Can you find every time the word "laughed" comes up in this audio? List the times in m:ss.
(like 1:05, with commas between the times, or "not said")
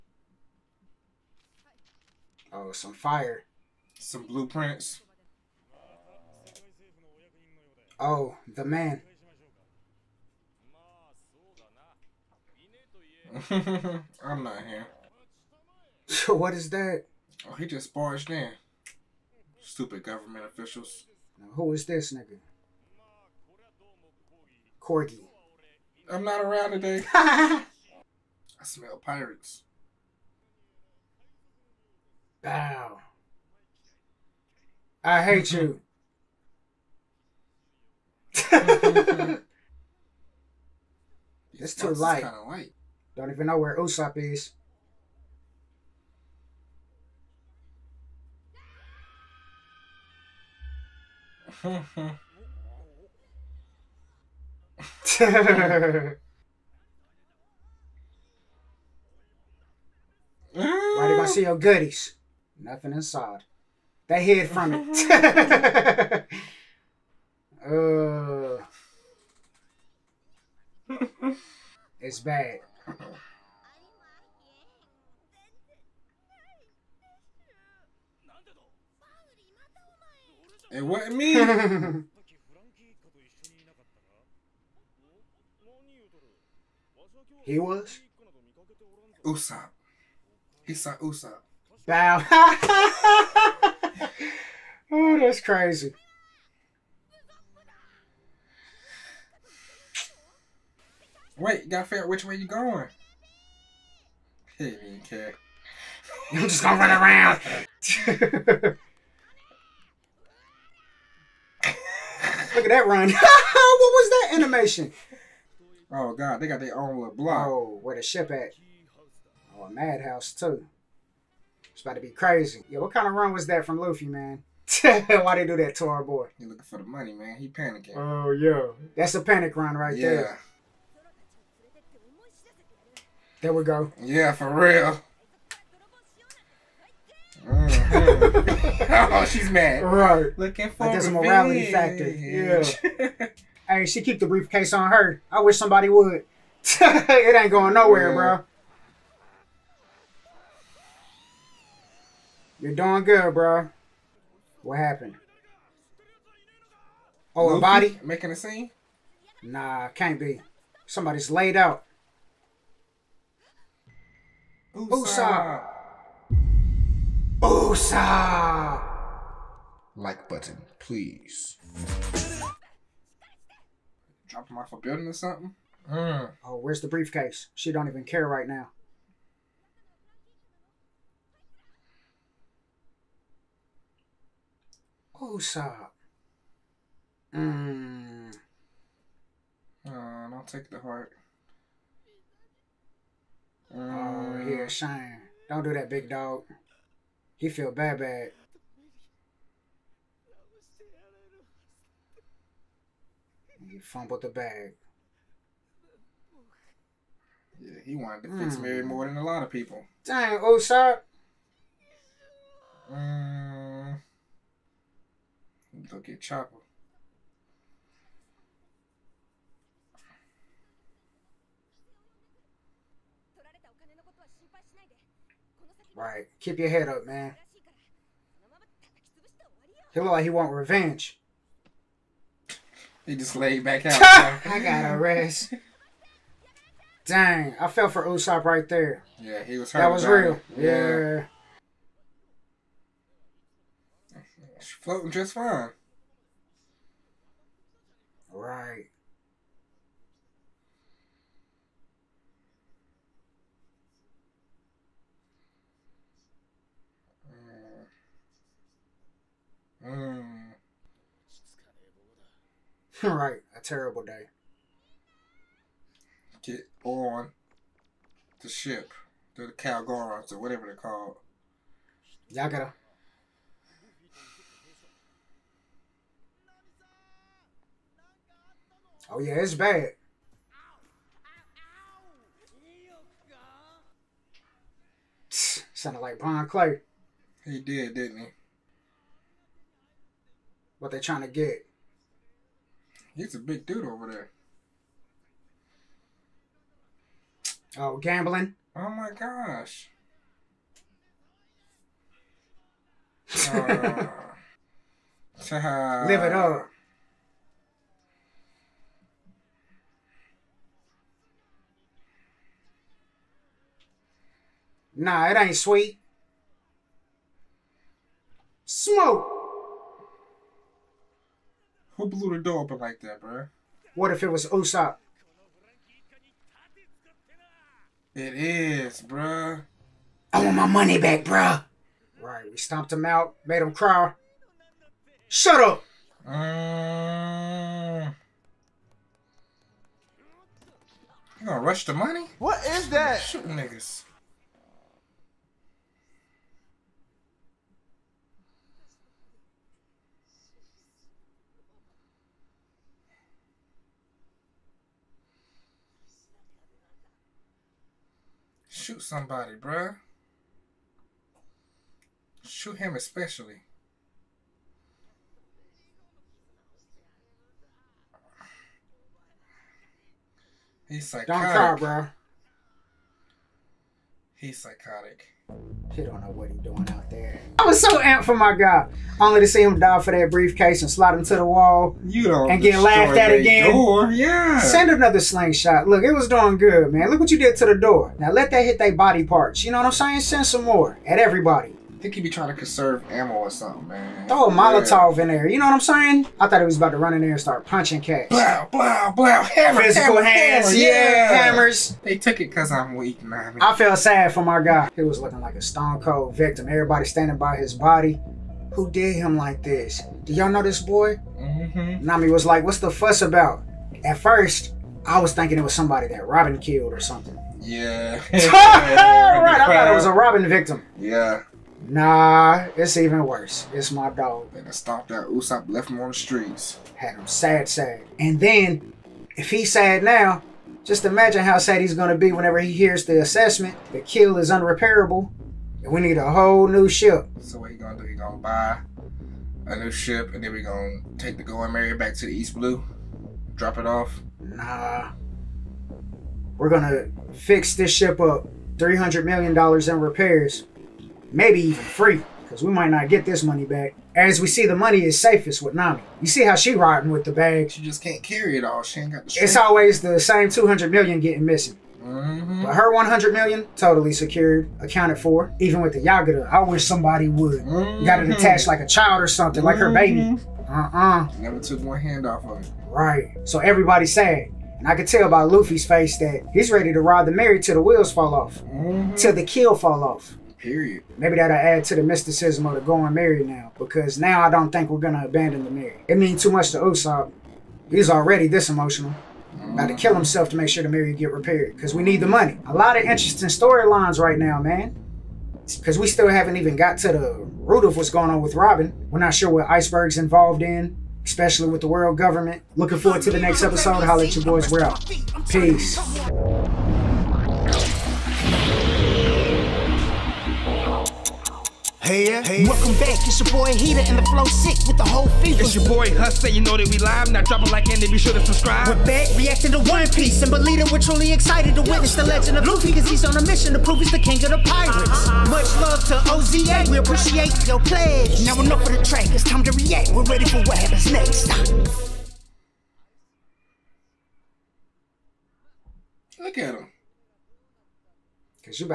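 6:22.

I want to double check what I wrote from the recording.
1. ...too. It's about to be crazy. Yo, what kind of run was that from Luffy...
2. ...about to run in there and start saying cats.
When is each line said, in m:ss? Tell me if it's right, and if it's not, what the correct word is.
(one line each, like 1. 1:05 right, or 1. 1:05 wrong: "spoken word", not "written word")
1. 2:00 right
2. 6:36 wrong: "punching", not "saying".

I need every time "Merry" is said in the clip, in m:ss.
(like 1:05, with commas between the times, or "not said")
3:28, 7:21, 7:57.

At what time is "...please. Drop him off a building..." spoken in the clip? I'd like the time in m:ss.
2:50.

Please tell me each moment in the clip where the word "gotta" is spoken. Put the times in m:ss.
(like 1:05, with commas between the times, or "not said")
1:41, 4:32.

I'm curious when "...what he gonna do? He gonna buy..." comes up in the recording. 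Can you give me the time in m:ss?
7:17.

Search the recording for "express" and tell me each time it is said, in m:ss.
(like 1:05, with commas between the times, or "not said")
not said.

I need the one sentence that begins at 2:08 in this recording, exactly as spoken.
That's a panic run right yeah.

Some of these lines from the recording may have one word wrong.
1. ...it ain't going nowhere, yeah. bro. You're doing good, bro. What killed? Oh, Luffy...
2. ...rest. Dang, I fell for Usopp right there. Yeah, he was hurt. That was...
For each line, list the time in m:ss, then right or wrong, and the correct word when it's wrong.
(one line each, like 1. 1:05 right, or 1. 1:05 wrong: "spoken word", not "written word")
1. 2:26 wrong: "happened", not "killed"
2. 3:54 right.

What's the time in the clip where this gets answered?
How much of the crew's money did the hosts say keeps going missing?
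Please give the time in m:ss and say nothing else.
7:40.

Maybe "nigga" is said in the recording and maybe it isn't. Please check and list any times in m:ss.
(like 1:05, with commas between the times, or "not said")
0:22, 5:43.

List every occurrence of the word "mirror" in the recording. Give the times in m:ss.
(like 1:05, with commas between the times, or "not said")
8:05, 8:10.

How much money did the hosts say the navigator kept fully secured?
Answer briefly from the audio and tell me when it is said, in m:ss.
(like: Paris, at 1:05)
100 million, at 7:42.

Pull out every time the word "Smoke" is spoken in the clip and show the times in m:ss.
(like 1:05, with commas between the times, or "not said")
5:18.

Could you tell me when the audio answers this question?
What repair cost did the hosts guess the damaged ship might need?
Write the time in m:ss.
7:28.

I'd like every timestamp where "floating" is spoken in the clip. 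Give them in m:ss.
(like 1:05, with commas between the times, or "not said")
4:04.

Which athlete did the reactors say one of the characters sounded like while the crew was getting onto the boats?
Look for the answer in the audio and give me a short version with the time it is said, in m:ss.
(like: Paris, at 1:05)
Brian Clay, at 4:46.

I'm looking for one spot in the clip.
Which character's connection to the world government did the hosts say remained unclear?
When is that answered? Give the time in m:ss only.
8:19.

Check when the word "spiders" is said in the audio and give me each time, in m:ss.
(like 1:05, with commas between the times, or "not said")
not said.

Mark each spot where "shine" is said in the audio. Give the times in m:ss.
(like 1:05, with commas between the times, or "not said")
3:14.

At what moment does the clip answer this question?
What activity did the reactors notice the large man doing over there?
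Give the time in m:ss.
4:57.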